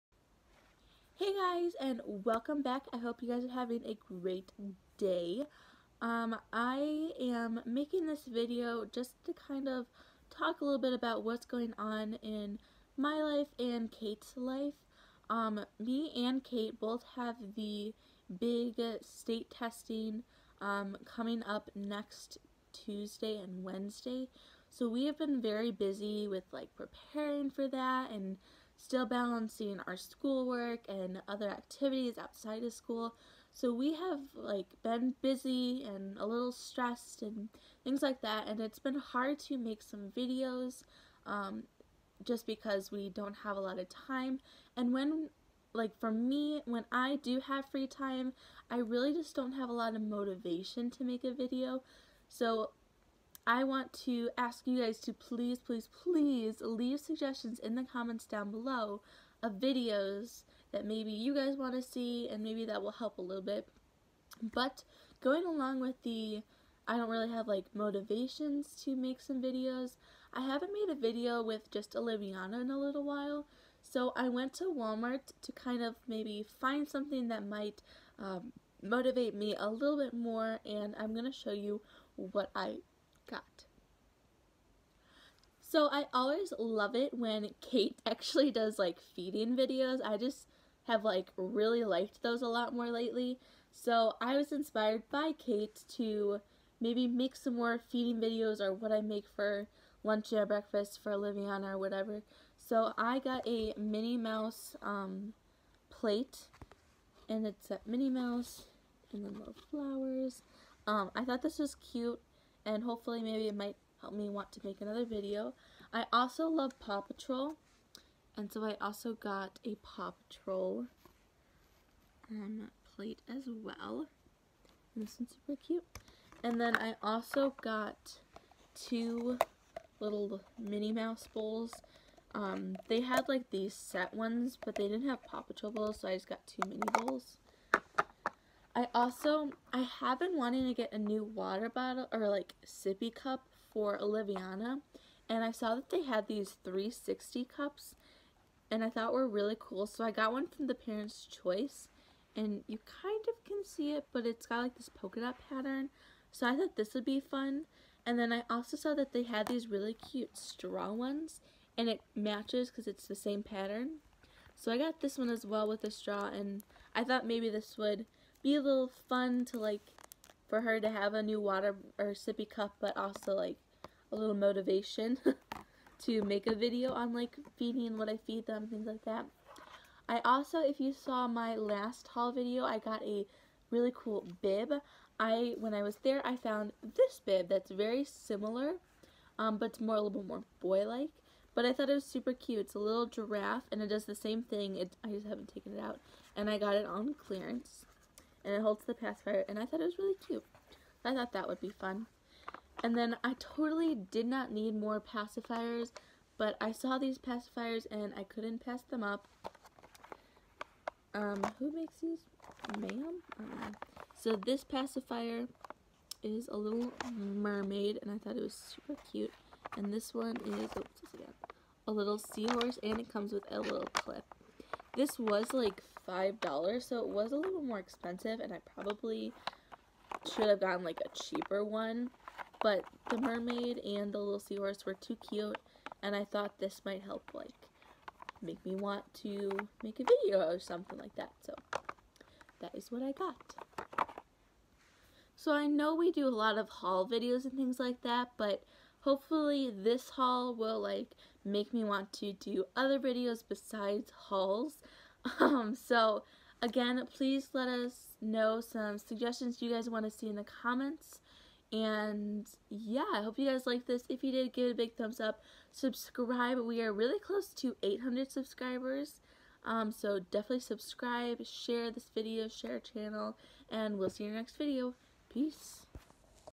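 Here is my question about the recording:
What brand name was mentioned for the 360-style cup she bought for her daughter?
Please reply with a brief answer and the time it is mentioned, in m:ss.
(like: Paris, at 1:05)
Parents' Choice, at 2:30.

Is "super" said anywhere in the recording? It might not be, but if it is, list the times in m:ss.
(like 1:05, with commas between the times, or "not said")
2:05, 3:12, 3:38.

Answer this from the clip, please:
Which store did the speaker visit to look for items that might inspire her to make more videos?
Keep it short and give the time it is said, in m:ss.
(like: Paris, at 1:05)
Walmart, at 1:14.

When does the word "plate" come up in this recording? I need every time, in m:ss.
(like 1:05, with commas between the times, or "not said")
1:45, 2:02.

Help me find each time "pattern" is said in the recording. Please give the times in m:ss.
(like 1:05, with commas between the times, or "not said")
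2:35, 2:43.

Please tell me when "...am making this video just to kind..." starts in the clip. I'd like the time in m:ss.
0:07.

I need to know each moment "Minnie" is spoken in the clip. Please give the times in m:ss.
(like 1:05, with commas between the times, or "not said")
1:43, 1:47, 2:10.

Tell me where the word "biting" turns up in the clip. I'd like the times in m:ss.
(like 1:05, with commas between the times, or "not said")
not said.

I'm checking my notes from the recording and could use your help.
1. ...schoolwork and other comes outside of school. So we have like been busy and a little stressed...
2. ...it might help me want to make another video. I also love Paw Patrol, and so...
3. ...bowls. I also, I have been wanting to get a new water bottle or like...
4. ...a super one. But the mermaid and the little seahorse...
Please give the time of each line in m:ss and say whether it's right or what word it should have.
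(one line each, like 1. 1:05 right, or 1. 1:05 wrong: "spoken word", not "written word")
1. 0:29 wrong: "activities", not "comes"
2. 1:53 right
3. 2:16 right
4. 3:51 wrong: "cheaper", not "super".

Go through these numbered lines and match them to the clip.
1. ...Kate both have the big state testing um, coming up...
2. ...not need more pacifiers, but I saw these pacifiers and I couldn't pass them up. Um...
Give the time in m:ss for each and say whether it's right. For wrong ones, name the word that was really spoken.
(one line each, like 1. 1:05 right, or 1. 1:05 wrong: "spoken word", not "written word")
1. 0:16 right
2. 3:24 right.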